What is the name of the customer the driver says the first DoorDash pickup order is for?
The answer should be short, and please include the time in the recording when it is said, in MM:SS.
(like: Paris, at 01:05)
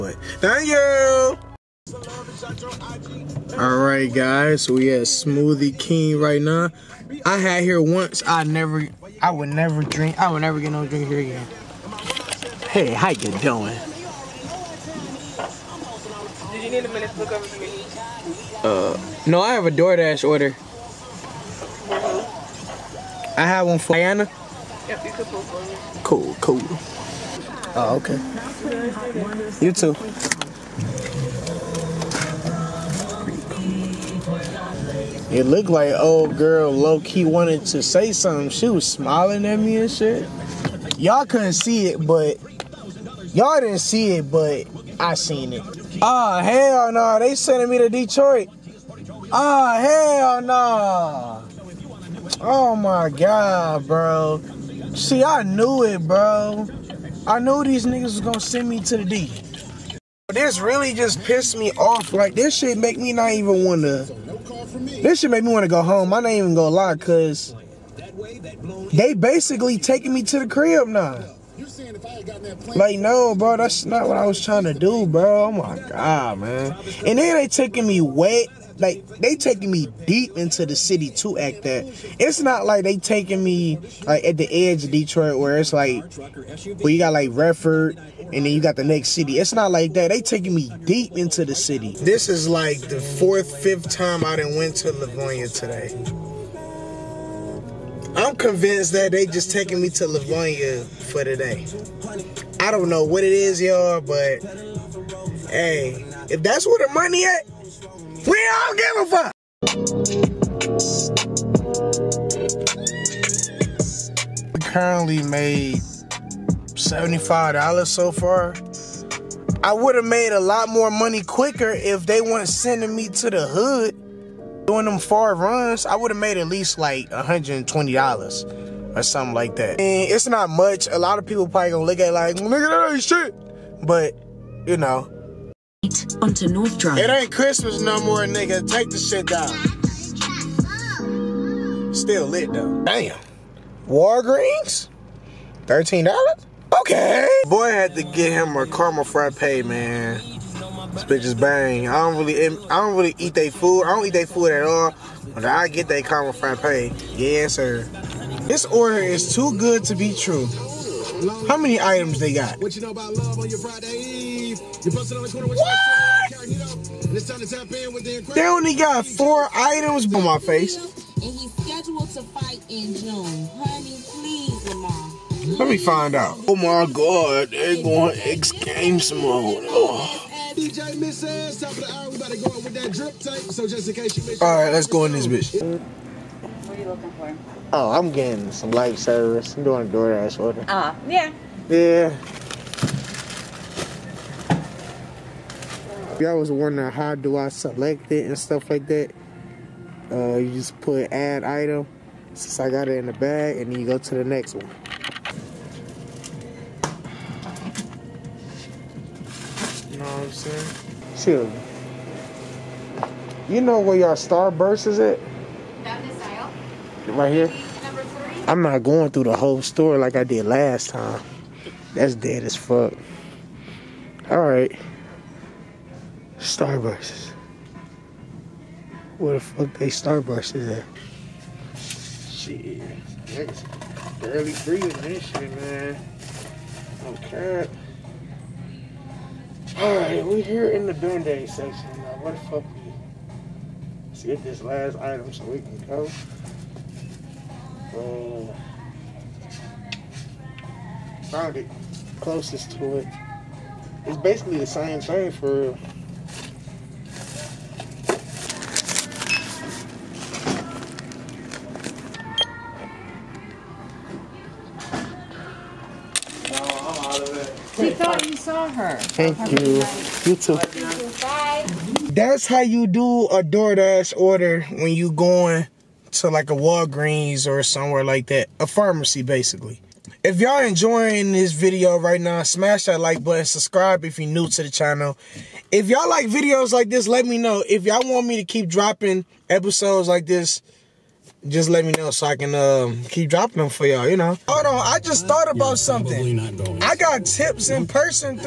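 Diana, at 00:23.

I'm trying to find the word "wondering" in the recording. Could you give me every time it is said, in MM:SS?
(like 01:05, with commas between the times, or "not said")
03:16.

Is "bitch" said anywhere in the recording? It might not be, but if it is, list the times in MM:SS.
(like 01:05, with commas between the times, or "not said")
02:31, 03:05.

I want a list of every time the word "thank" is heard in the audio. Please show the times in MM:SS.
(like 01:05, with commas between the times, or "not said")
00:00, 04:29.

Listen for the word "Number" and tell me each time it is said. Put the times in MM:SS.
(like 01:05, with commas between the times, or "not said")
03:37.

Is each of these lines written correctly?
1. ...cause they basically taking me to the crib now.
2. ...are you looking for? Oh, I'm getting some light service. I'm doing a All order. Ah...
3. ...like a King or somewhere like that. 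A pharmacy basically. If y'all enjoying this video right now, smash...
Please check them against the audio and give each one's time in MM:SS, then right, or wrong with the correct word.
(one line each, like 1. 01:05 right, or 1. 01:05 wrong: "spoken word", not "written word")
1. 01:06 right
2. 03:06 wrong: "DoorDash", not "All"
3. 04:36 wrong: "Walgreens", not "King".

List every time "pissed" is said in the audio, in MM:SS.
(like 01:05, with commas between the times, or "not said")
01:01.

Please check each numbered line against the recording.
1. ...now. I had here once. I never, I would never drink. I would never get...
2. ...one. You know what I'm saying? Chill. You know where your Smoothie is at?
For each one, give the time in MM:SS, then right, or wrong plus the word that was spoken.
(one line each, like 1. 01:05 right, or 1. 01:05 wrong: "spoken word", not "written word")
1. 00:06 right
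2. 03:24 wrong: "Starburst", not "Smoothie".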